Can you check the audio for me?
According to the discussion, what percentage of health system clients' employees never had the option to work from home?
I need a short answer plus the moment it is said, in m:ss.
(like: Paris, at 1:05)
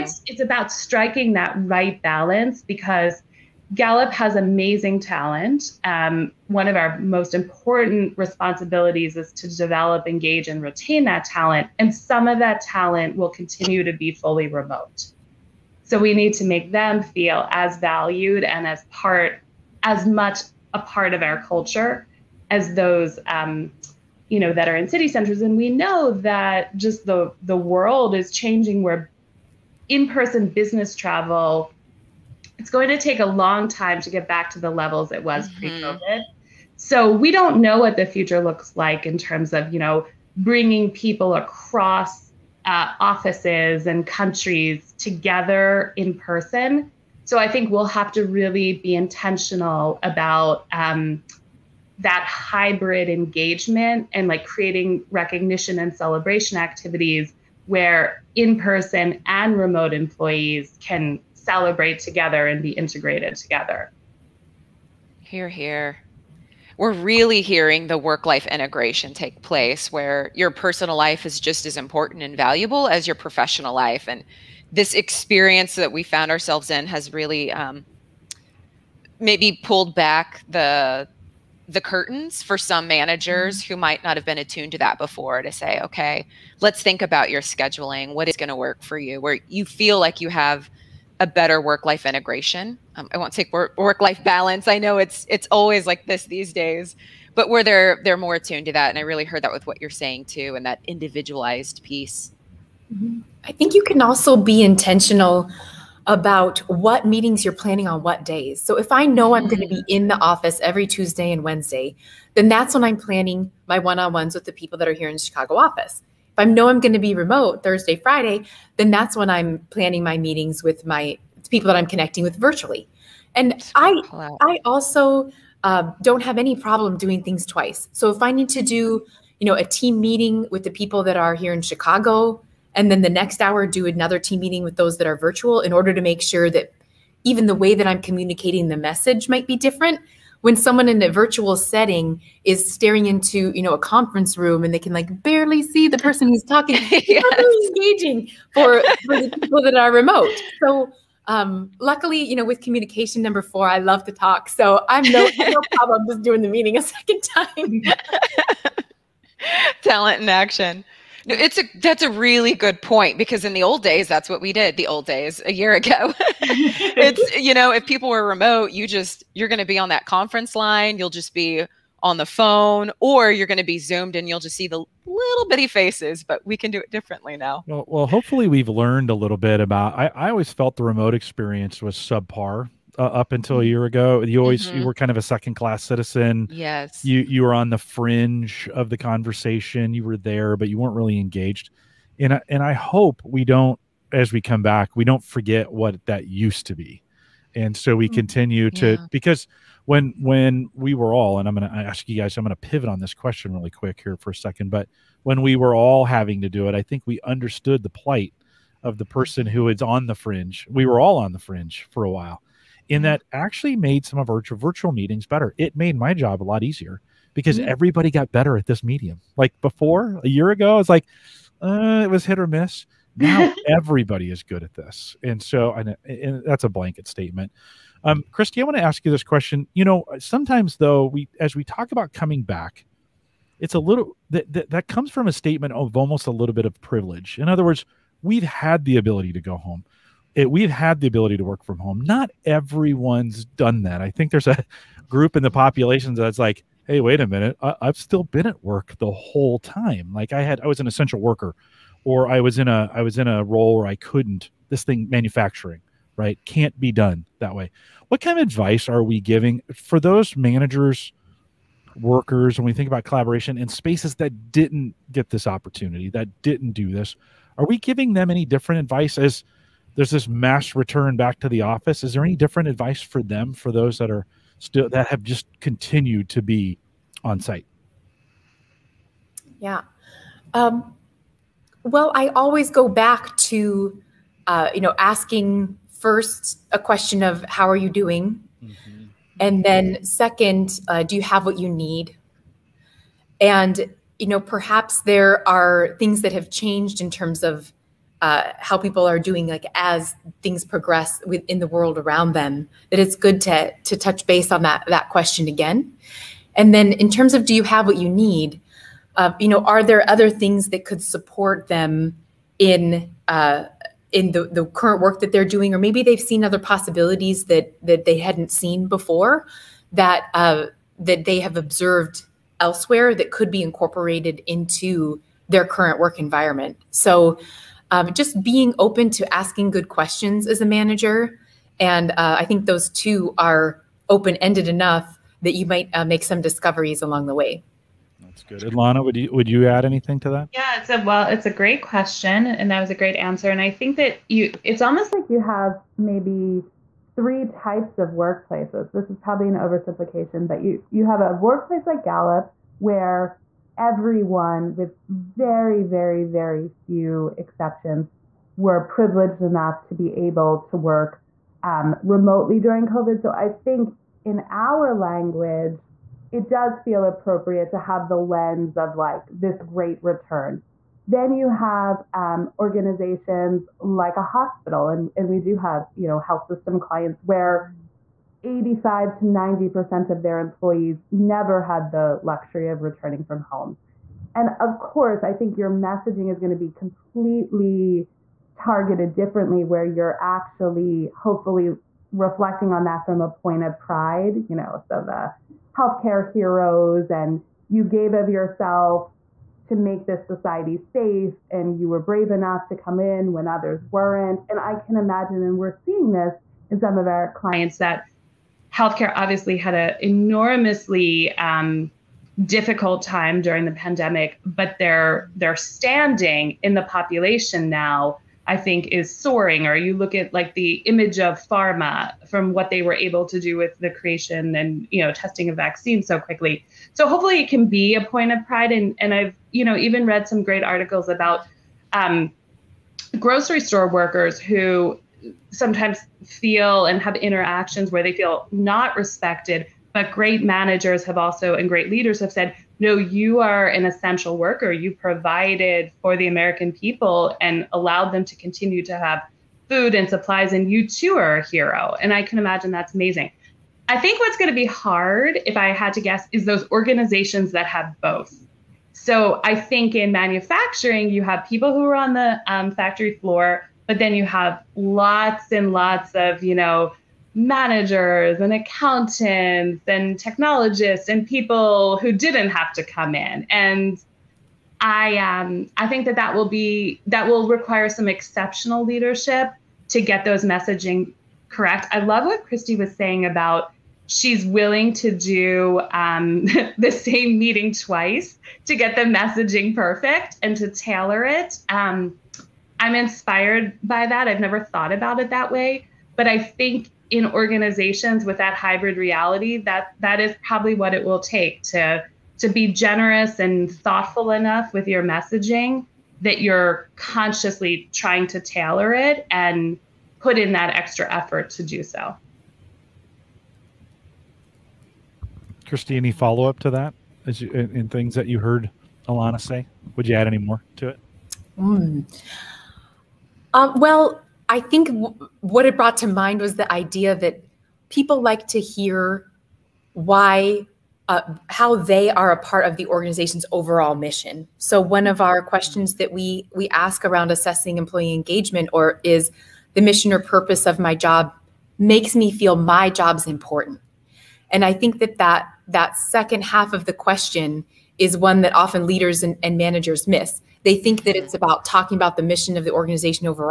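85 to 90%, at 6:18.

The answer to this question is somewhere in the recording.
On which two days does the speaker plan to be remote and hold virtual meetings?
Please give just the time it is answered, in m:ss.
1:57.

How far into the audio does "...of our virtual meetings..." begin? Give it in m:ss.
3:34.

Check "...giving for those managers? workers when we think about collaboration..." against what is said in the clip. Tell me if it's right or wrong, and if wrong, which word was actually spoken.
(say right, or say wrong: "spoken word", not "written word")
right.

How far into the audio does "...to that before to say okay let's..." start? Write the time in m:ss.
1:24.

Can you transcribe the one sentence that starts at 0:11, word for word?
And some of that talent will continue to be fully remote.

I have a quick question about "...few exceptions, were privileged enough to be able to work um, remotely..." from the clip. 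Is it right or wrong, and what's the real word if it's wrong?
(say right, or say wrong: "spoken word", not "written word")
right.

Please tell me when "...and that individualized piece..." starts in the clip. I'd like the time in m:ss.
1:40.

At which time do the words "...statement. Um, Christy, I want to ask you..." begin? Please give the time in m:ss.
3:47.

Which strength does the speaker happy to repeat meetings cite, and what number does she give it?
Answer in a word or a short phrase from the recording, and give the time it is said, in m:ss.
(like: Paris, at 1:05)
Communication, number 4, at 2:32.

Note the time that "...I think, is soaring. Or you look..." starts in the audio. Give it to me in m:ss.
6:58.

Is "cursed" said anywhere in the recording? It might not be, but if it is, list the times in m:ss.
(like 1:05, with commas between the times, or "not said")
not said.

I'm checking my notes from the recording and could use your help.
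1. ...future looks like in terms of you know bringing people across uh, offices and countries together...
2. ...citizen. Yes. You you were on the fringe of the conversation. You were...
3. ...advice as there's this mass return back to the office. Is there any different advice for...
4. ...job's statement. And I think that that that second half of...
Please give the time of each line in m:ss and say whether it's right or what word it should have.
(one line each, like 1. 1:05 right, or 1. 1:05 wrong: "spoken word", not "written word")
1. 0:38 right
2. 3:05 right
3. 4:28 right
4. 9:02 wrong: "important", not "statement".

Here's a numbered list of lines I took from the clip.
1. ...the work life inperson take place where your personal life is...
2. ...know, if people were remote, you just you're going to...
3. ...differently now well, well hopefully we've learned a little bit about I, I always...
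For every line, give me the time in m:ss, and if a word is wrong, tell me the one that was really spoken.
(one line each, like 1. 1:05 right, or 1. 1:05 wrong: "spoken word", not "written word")
1. 1:07 wrong: "integration", not "inperson"
2. 2:47 right
3. 2:56 right.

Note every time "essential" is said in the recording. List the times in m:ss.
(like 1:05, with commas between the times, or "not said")
4:10, 7:23.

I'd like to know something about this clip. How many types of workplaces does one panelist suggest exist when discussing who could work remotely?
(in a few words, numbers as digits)
3.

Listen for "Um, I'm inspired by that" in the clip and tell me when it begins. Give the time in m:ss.
8:11.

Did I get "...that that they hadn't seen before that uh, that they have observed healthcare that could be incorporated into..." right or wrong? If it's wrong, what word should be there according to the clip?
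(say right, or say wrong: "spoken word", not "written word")
wrong: "elsewhere", not "healthcare".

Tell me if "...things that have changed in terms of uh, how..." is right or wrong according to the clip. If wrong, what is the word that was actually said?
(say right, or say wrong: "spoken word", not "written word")
right.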